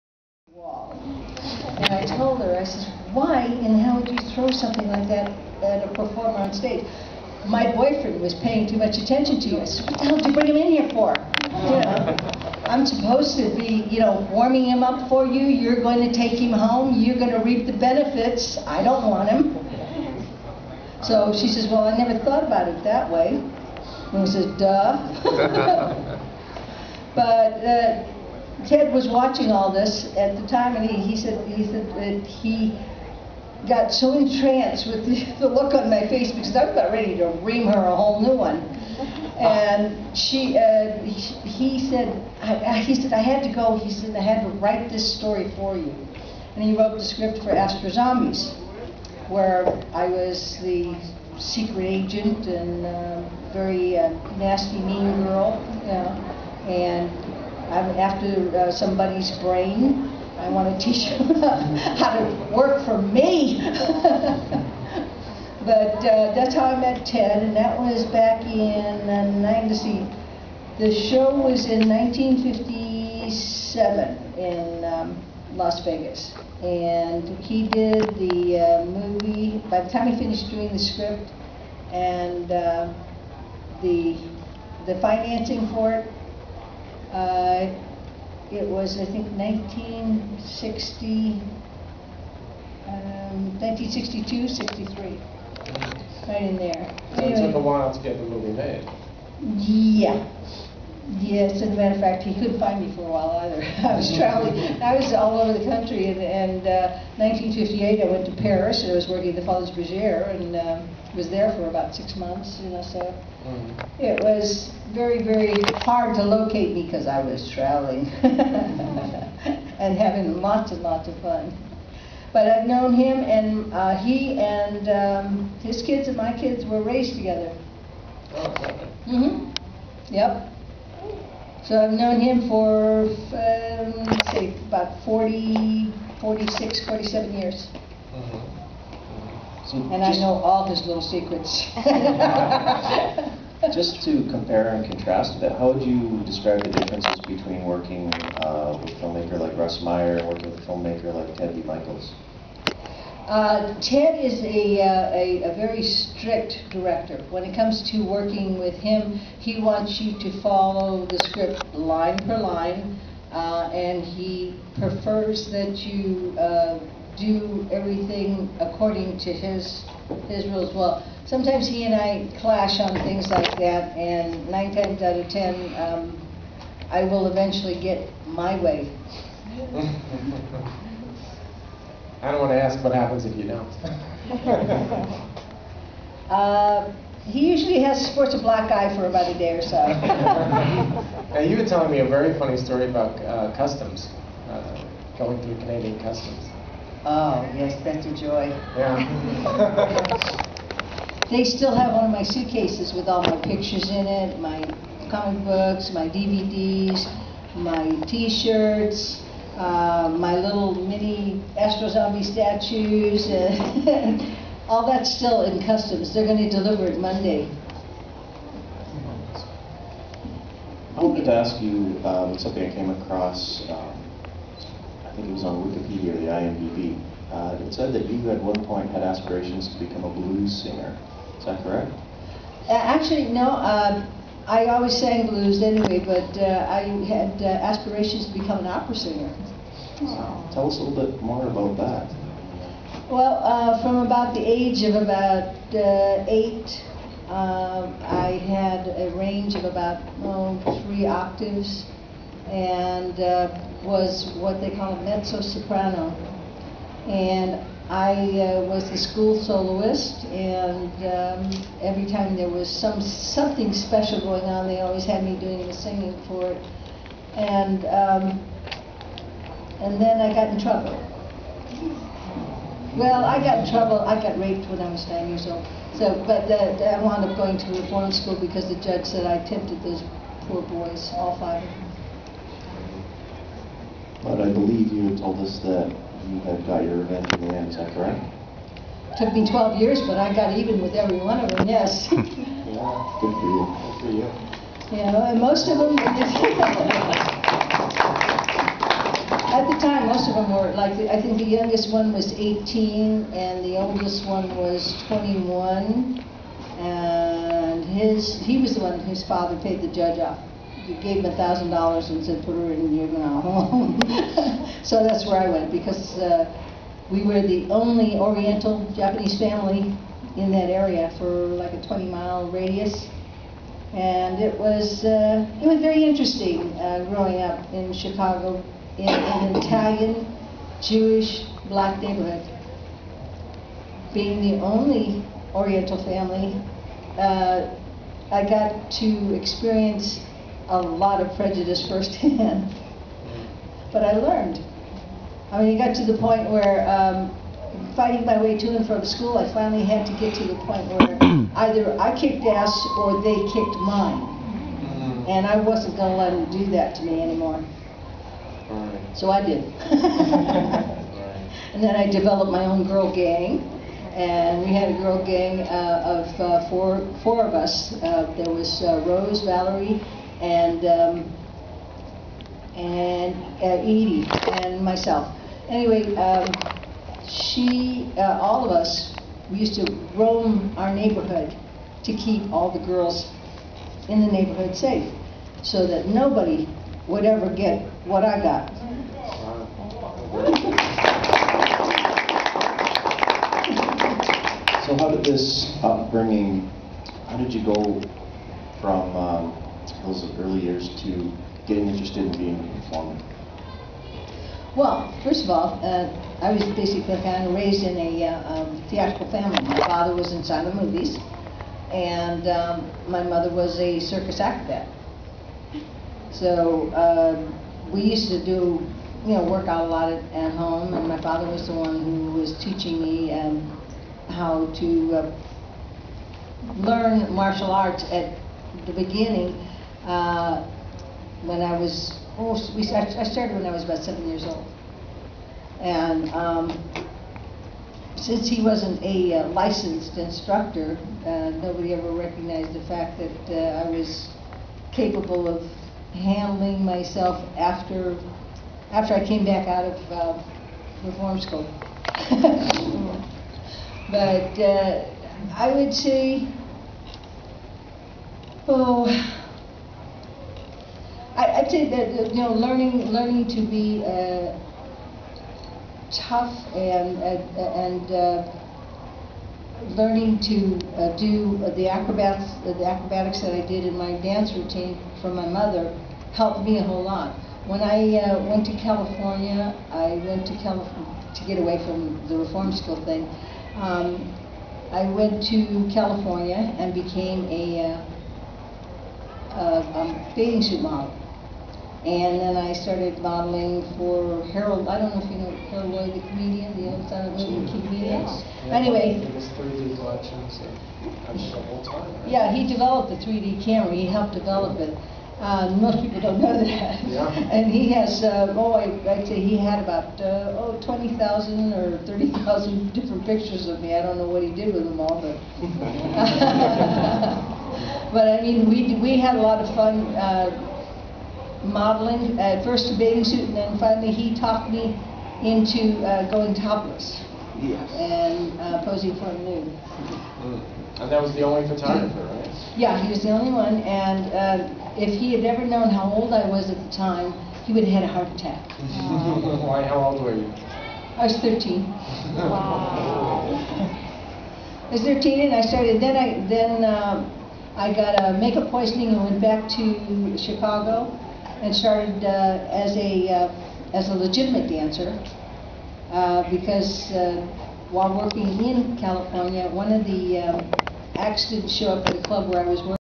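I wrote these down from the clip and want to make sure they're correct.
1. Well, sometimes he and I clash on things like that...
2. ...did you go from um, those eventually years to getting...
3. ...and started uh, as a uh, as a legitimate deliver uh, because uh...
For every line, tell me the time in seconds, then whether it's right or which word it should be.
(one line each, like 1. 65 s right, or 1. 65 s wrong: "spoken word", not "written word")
1. 170 s right
2. 397 s wrong: "early", not "eventually"
3. 551 s wrong: "dancer", not "deliver".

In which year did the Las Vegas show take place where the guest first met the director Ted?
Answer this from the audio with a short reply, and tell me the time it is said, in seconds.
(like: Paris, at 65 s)
1957, at 71 s.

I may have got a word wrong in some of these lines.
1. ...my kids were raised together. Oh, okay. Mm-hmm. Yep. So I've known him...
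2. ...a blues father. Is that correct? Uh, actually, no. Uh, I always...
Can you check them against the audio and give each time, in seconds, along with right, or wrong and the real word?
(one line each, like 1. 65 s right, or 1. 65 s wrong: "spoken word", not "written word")
1. 126 s right
2. 230 s wrong: "singer", not "father".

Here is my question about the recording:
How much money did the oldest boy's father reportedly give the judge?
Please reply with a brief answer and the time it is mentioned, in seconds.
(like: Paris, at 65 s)
$1,000, at 311 s.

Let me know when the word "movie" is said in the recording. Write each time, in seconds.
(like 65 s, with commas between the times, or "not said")
78 s, 98 s, 410 s, 497 s.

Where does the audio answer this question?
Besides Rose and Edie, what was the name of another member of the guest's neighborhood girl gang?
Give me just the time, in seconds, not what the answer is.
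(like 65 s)
369 s.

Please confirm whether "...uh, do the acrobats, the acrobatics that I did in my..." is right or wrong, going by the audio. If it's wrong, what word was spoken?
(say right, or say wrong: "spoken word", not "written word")
right.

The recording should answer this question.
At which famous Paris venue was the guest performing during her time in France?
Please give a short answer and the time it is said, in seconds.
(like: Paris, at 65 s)
Folies Bergère, at 109 s.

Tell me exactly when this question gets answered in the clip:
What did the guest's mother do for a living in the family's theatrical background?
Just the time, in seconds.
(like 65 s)
413 s.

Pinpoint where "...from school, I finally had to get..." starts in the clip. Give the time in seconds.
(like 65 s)
348 s.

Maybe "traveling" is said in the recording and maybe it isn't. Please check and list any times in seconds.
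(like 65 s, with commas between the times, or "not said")
104 s, 117 s.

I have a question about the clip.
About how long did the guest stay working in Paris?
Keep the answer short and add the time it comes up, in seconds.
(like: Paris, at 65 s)
Six months, at 111 s.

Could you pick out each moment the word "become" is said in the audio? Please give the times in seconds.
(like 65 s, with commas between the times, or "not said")
229 s, 238 s.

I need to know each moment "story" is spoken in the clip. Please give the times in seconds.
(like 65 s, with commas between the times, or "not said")
45 s, 192 s.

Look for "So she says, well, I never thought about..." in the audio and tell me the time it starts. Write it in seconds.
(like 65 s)
21 s.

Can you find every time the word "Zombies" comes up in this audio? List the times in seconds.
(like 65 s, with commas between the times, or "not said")
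47 s, 211 s.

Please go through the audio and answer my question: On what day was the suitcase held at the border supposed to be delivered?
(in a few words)
Monday.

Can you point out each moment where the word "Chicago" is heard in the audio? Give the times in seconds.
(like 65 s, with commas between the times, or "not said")
327 s, 550 s.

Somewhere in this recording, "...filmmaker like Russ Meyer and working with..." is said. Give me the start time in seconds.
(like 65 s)
148 s.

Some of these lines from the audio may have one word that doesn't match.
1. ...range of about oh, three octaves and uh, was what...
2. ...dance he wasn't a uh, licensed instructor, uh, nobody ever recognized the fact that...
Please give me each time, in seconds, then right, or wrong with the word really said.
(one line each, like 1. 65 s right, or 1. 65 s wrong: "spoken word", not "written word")
1. 249 s right
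2. 438 s wrong: "since", not "dance".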